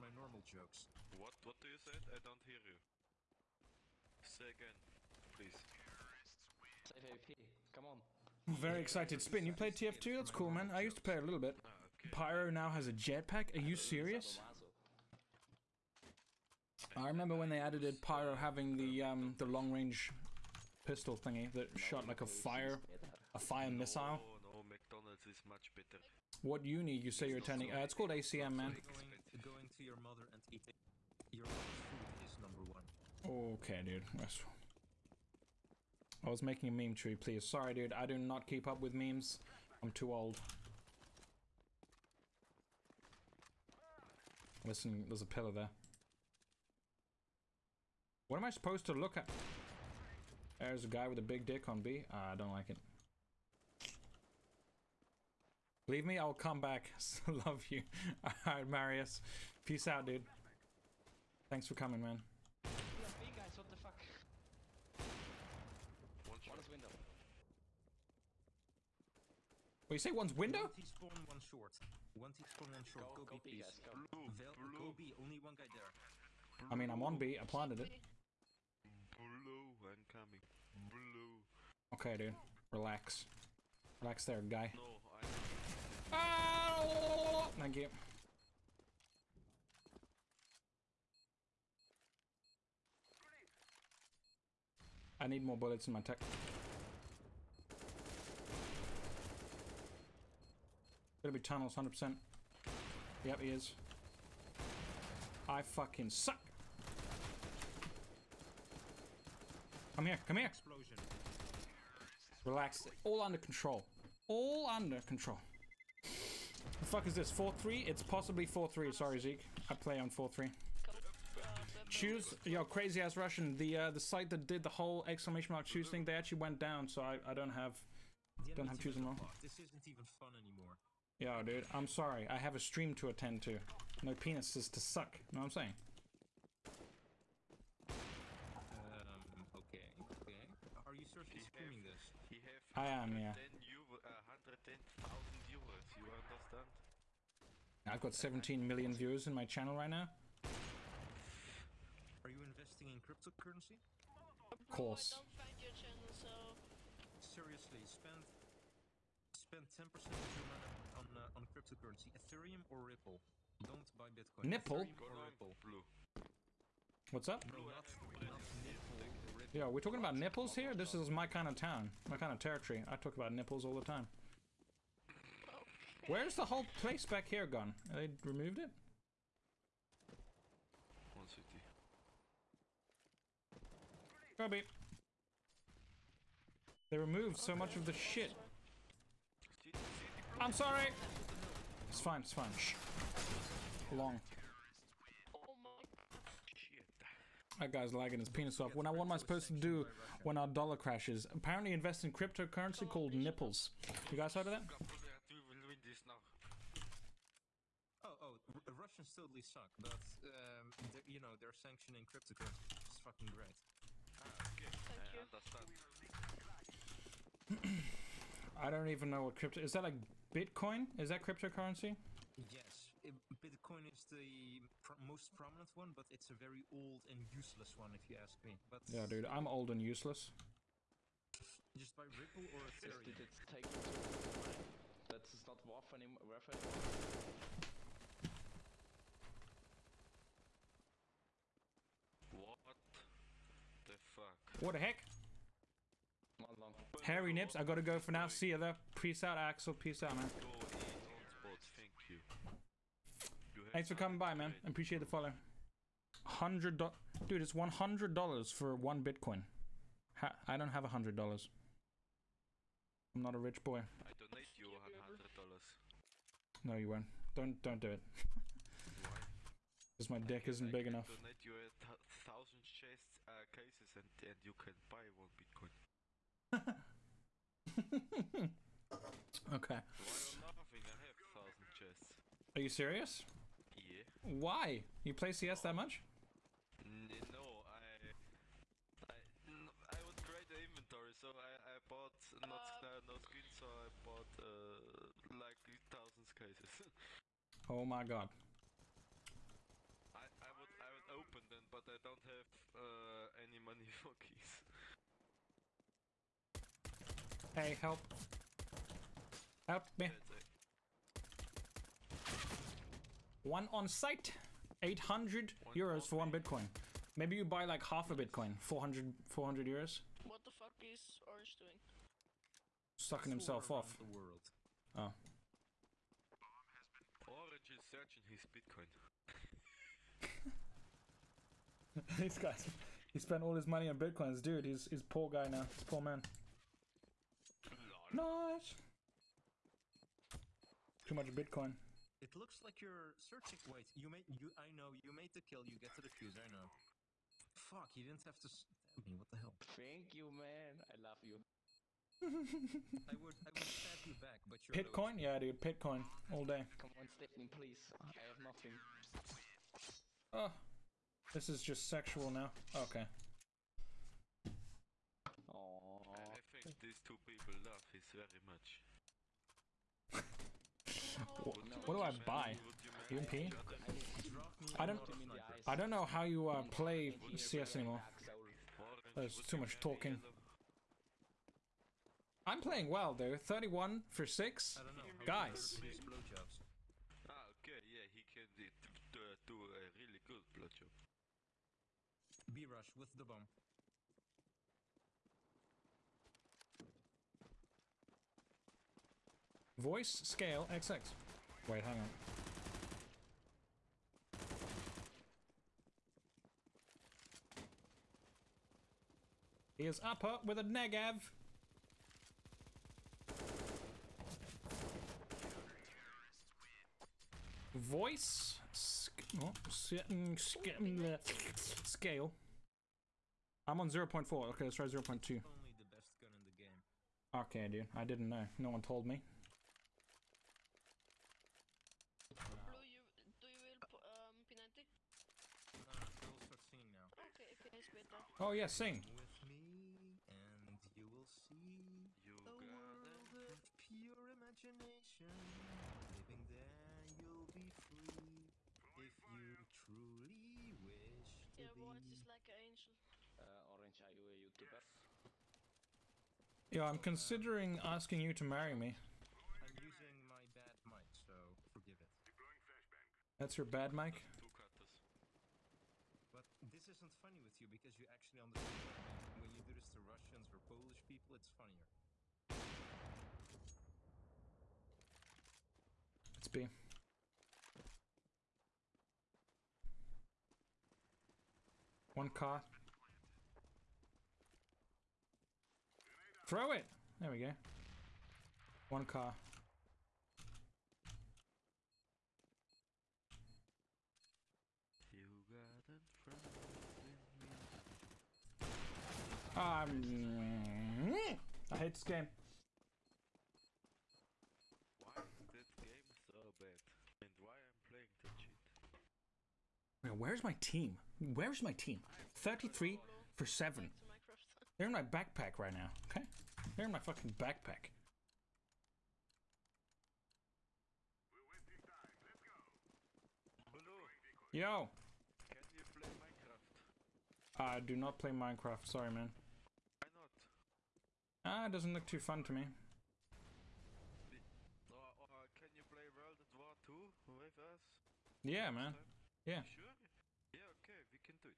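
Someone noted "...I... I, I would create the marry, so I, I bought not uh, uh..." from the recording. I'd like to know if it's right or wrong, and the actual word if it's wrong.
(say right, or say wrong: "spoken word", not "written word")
wrong: "inventory", not "marry".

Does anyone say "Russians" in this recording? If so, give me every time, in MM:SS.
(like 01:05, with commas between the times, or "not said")
02:03, 03:28, 07:49.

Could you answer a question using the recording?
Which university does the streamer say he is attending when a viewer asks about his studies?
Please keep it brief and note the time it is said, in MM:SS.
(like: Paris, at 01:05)
ACM, at 00:27.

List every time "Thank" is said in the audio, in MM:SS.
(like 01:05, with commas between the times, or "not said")
01:01, 01:27, 03:34, 04:13, 05:49.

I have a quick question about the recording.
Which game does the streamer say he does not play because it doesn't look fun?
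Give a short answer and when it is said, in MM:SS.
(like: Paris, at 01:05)
Minecraft, at 08:48.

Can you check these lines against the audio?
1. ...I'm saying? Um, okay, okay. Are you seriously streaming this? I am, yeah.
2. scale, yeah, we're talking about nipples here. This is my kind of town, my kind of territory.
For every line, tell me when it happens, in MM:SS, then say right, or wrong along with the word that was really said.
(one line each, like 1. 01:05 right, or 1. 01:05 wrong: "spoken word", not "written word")
1. 02:15 right
2. 02:47 wrong: "nipple", not "scale".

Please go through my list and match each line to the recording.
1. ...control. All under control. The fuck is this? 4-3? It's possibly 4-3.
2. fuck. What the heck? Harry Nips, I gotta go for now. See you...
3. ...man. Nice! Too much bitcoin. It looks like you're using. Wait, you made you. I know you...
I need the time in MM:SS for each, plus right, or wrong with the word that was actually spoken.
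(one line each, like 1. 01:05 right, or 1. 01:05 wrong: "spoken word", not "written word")
1. 01:53 right
2. 04:04 right
3. 05:35 wrong: "searching", not "using".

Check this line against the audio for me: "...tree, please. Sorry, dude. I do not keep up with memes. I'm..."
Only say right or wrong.
right.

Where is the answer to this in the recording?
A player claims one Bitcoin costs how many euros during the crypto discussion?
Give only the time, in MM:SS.
05:14.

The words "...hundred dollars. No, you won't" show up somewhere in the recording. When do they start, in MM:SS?
04:24.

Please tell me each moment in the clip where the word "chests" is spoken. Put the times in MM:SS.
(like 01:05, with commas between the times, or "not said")
04:32, 04:41.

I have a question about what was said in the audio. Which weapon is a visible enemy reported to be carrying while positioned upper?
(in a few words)
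Negev.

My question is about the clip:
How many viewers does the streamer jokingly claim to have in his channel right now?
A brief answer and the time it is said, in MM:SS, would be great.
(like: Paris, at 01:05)
17 million, at 02:28.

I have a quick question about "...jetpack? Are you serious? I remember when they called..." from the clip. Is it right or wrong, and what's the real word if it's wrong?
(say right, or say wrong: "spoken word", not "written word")
wrong: "added", not "called".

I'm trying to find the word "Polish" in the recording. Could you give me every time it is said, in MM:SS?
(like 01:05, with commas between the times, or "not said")
07:50.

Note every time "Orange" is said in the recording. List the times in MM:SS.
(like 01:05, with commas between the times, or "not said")
05:21, 05:27, 07:33.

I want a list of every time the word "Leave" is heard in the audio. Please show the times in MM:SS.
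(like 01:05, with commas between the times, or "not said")
00:55.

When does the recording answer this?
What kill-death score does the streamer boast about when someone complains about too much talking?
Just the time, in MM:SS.
06:23.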